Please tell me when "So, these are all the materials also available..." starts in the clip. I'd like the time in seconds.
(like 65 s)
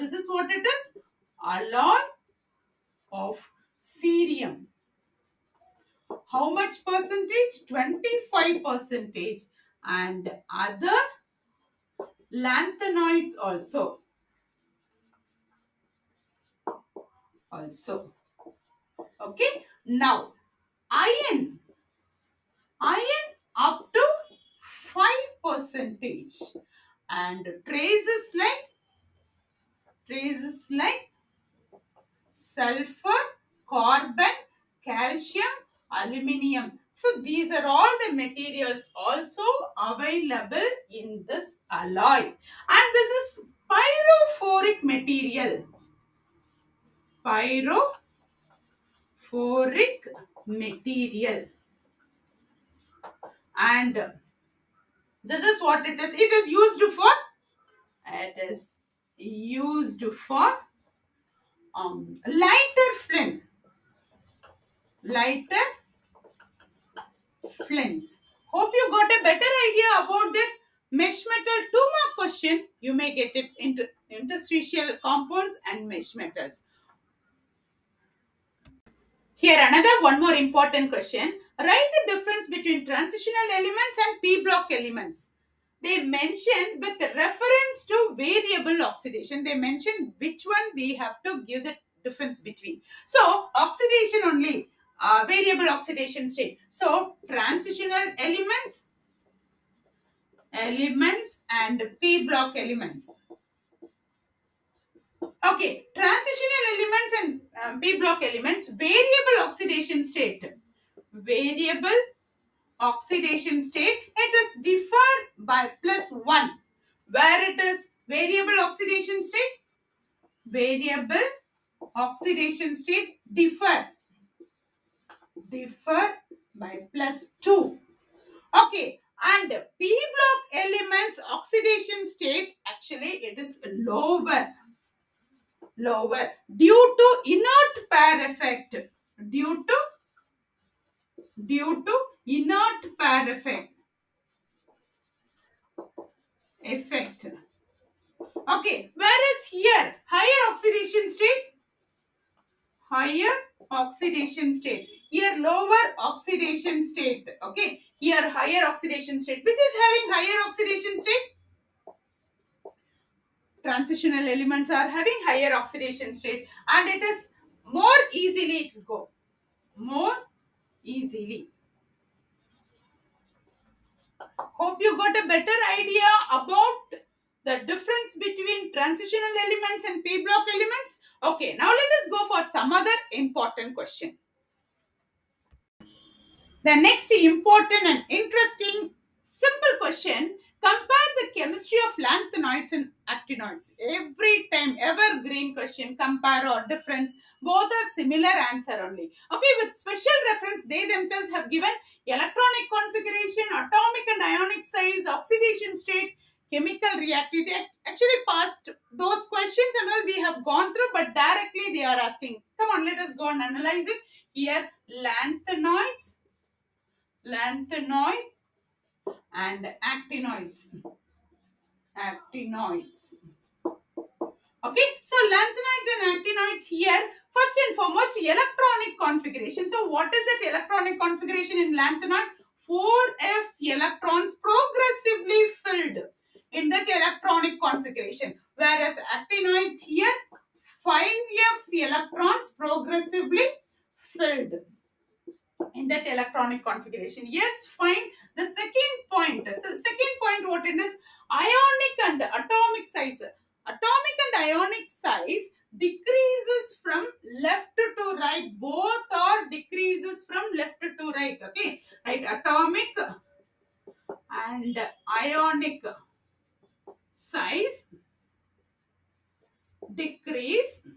36 s.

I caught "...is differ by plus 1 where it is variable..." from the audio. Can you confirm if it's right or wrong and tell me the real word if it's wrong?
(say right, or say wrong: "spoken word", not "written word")
right.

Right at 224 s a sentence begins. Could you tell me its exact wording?
Okay, so lanthanides and actinoids here.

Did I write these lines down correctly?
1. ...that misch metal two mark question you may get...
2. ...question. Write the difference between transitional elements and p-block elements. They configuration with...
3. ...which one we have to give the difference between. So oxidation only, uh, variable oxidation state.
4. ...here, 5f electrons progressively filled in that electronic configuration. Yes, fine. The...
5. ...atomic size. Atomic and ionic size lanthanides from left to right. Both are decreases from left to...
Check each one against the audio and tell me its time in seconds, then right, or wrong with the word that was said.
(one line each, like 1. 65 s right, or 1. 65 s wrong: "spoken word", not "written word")
1. 70 s right
2. 80 s wrong: "mention", not "configuration"
3. 90 s right
4. 239 s right
5. 252 s wrong: "decreases", not "lanthanides".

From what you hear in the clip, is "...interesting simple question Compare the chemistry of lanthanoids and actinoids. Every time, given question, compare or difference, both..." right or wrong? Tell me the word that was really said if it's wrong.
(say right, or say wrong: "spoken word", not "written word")
wrong: "evergreen", not "given".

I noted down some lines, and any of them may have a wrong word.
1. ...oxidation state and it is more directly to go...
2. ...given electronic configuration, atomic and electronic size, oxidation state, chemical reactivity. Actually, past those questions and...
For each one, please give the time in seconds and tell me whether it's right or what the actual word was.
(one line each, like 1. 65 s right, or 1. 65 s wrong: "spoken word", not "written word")
1. 165 s wrong: "easily", not "directly"
2. 201 s wrong: "ionic", not "electronic".